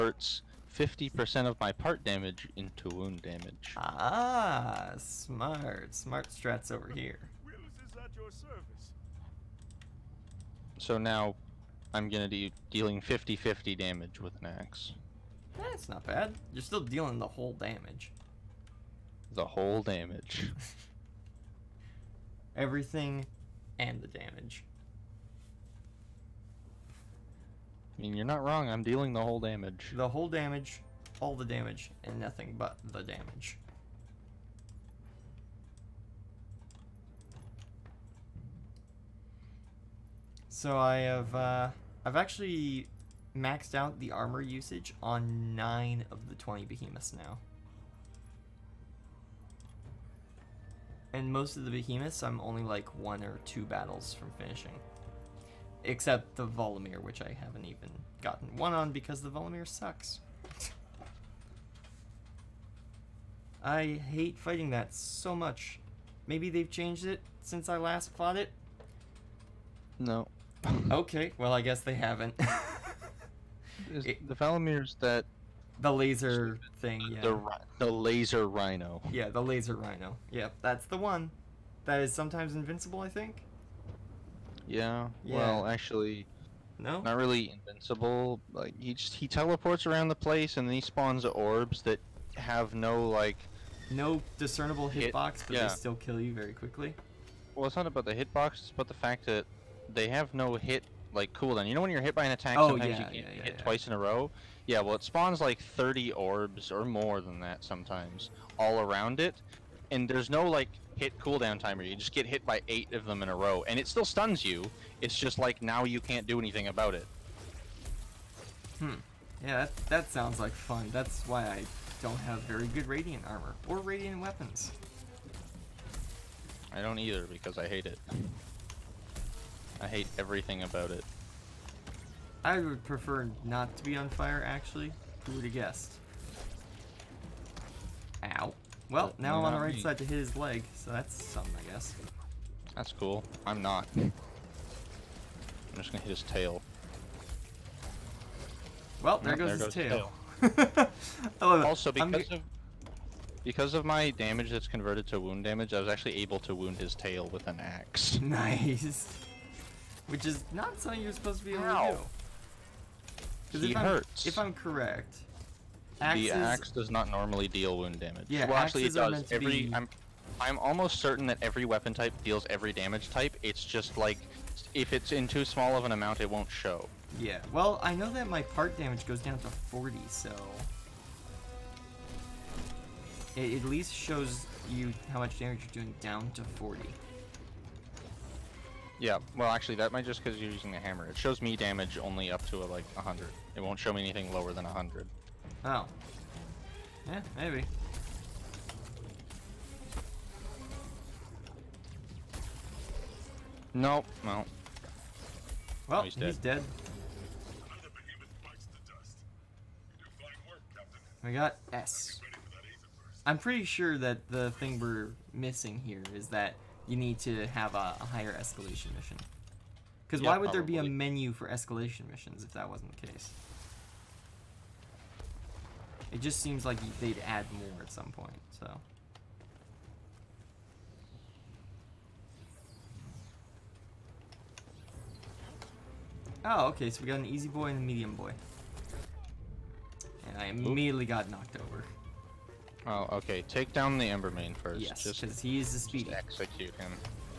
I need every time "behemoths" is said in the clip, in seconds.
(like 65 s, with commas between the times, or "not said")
46 s, 51 s.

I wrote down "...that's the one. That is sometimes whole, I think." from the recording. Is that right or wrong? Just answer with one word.
wrong.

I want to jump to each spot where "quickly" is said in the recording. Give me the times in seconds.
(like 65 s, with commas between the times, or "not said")
96 s.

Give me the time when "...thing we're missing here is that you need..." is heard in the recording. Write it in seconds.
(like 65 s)
214 s.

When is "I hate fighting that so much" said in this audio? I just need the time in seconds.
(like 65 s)
63 s.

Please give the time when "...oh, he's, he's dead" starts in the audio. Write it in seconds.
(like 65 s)
205 s.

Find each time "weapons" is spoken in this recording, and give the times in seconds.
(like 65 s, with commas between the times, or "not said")
124 s, 171 s.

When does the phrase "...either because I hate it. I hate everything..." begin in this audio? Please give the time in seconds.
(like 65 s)
126 s.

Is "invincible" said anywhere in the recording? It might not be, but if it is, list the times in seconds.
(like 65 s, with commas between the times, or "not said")
82 s, 87 s.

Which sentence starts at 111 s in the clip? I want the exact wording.
You just get hit by eight of them in a row, and it still stuns you.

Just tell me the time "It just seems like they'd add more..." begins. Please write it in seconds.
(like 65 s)
226 s.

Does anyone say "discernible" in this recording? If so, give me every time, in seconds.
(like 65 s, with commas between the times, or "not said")
94 s.